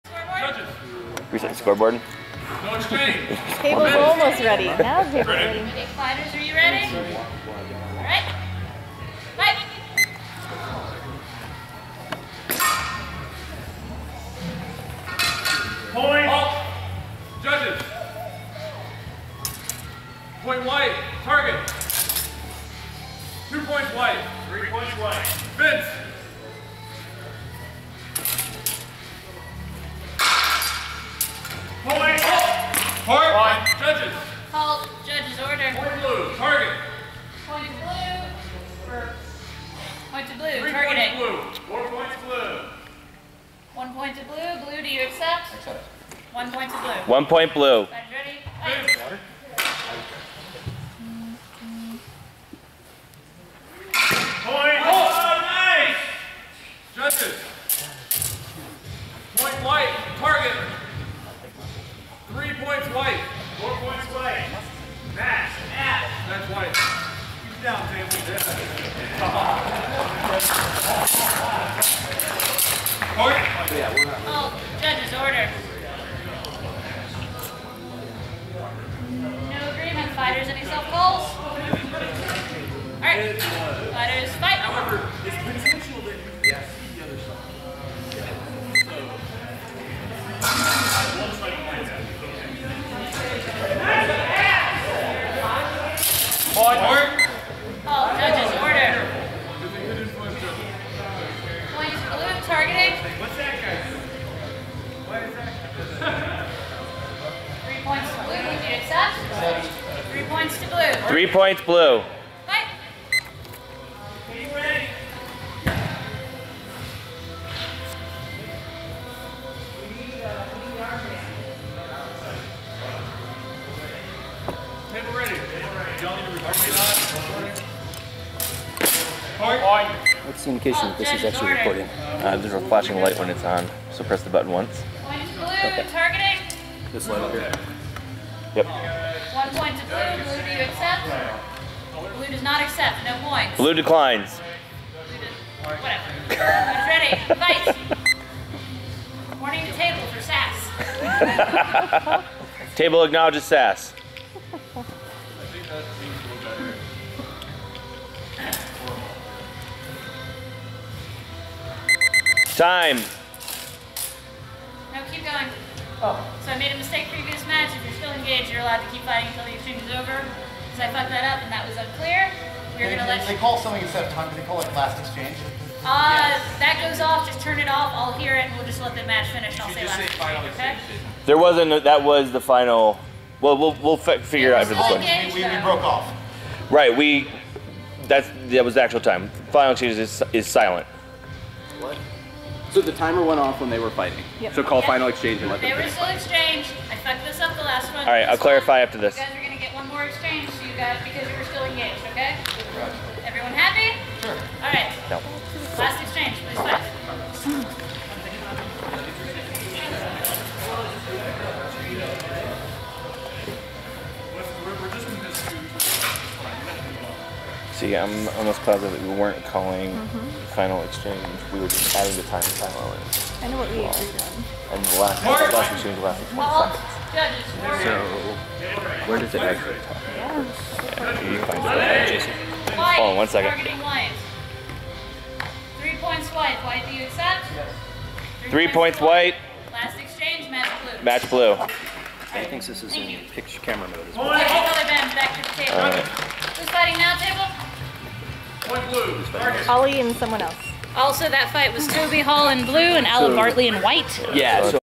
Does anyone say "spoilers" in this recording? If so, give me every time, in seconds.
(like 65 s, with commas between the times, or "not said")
not said.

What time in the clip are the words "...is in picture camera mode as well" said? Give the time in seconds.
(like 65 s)
242 s.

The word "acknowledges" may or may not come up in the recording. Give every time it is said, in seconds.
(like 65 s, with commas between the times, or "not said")
153 s.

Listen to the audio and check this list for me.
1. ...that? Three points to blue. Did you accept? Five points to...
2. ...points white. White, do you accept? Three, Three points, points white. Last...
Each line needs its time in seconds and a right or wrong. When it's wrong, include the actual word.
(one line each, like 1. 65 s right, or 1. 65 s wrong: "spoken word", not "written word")
1. 106 s wrong: "Three", not "Five"
2. 236 s right.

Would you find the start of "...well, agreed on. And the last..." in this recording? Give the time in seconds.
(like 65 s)
223 s.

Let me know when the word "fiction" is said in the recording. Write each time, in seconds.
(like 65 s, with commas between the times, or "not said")
not said.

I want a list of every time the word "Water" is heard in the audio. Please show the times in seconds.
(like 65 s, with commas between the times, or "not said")
48 s.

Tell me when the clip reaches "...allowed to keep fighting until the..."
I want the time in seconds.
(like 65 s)
168 s.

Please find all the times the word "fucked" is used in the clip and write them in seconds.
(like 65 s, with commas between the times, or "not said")
170 s, 196 s.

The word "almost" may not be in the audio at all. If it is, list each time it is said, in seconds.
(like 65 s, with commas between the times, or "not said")
3 s, 218 s.